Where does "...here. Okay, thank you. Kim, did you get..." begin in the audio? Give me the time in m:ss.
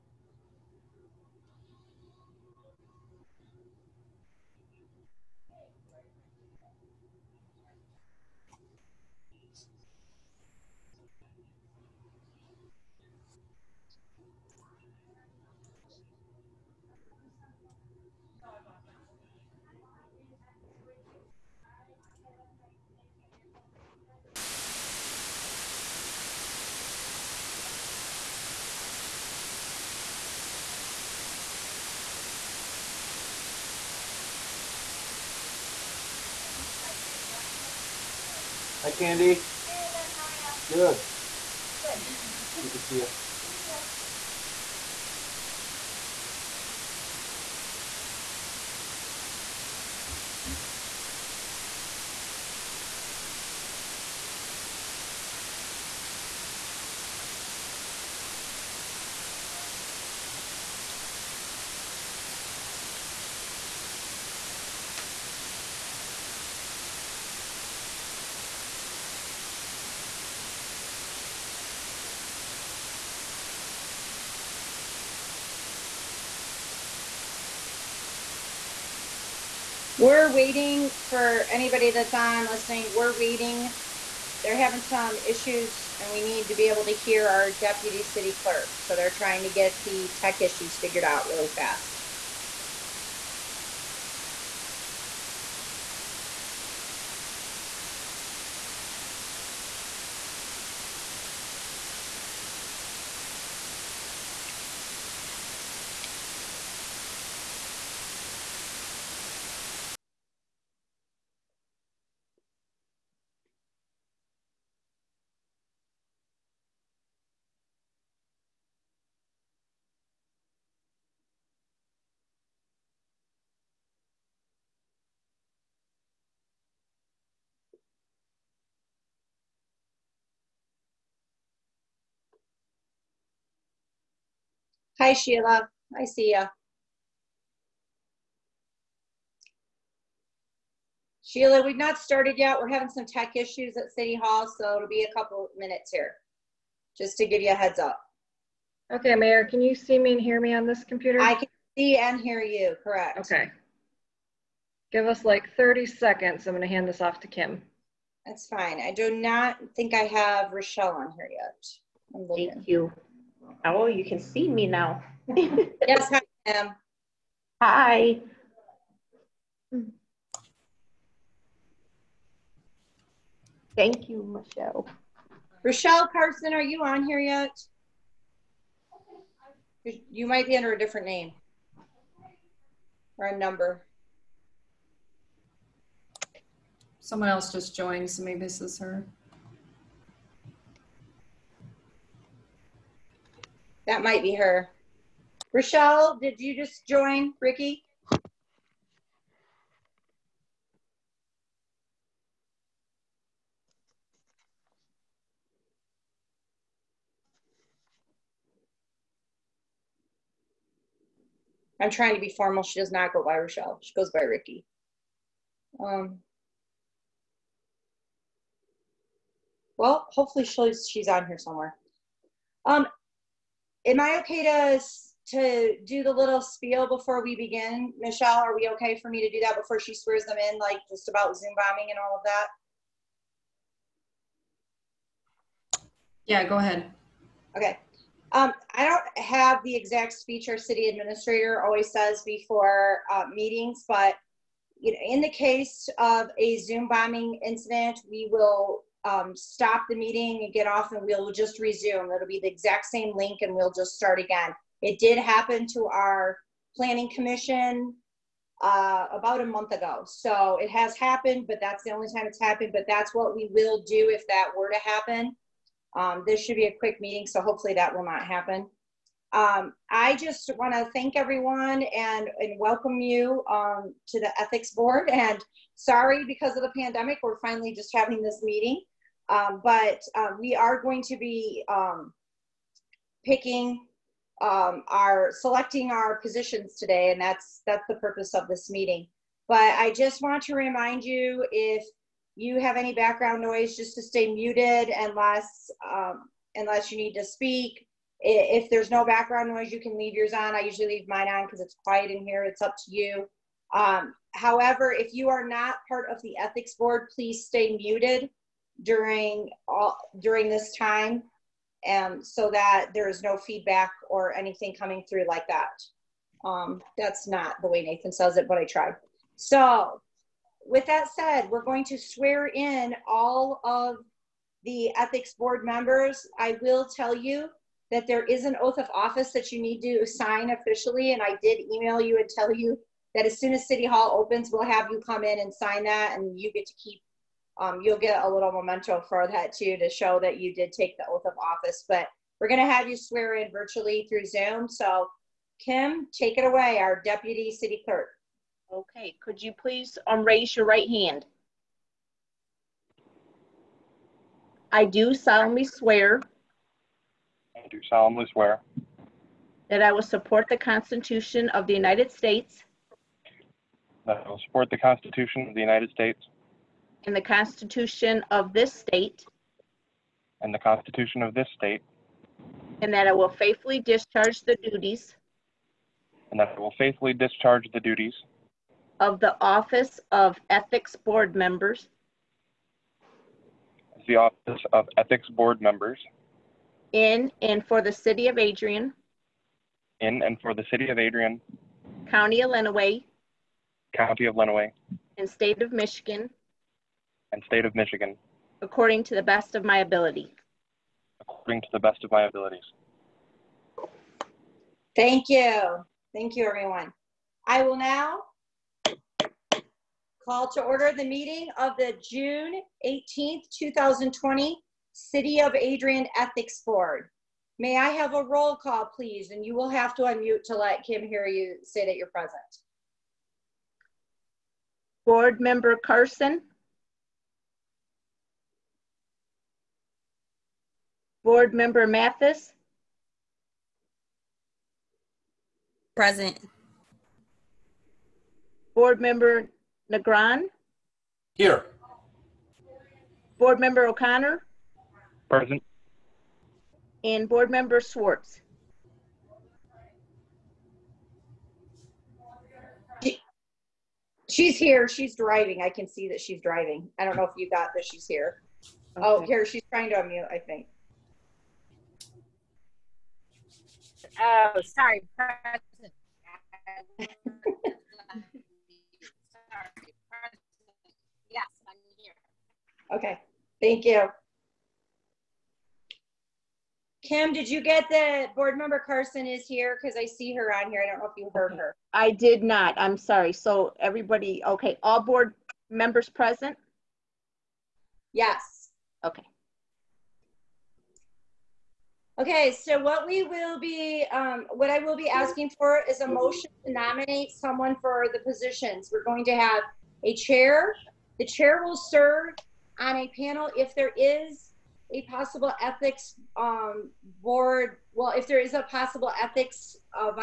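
7:51.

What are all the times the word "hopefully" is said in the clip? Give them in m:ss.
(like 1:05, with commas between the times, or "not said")
3:40, 4:27.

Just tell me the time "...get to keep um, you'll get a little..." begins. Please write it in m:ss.
5:36.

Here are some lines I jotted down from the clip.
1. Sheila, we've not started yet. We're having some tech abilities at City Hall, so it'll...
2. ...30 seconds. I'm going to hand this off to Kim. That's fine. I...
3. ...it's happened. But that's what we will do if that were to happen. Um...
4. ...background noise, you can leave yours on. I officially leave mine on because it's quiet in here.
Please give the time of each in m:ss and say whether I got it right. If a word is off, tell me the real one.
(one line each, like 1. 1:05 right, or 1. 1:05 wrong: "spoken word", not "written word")
1. 2:21 wrong: "issues", not "abilities"
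2. 2:35 right
3. 4:22 right
4. 4:59 wrong: "usually", not "officially".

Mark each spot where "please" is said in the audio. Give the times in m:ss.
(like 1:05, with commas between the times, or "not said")
5:07, 5:49, 6:58.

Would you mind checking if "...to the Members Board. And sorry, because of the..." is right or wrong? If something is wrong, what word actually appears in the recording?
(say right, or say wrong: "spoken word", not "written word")
wrong: "Ethics", not "Members".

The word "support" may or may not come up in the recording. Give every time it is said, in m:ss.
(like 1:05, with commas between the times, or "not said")
6:00, 6:04.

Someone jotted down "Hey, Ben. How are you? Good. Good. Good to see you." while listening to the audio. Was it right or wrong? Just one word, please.
right.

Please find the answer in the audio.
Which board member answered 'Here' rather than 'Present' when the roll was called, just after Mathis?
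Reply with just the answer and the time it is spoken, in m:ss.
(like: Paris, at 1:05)
Negron, at 7:18.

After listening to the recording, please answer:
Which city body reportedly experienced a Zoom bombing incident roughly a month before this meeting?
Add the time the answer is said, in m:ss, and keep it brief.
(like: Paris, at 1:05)
Planning commission, at 4:16.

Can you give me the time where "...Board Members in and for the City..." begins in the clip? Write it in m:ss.
6:25.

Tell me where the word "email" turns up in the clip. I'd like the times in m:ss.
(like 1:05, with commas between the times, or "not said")
5:31.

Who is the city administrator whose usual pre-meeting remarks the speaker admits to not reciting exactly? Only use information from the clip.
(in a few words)
Nathan.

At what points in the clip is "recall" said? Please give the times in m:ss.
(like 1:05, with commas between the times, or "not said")
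not said.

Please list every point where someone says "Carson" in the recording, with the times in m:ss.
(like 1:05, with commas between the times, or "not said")
2:56, 7:05, 7:58.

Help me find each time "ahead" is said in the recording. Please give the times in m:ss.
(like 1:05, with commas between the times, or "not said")
3:56.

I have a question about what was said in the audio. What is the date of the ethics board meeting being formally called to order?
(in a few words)
June 18th, 2020.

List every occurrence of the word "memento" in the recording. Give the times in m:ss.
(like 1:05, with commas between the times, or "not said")
5:38.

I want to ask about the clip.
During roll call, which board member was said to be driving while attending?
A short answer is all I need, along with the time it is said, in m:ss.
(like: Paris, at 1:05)
Schwartz, at 7:27.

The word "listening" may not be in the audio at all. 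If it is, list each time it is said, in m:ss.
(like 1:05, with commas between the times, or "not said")
1:22.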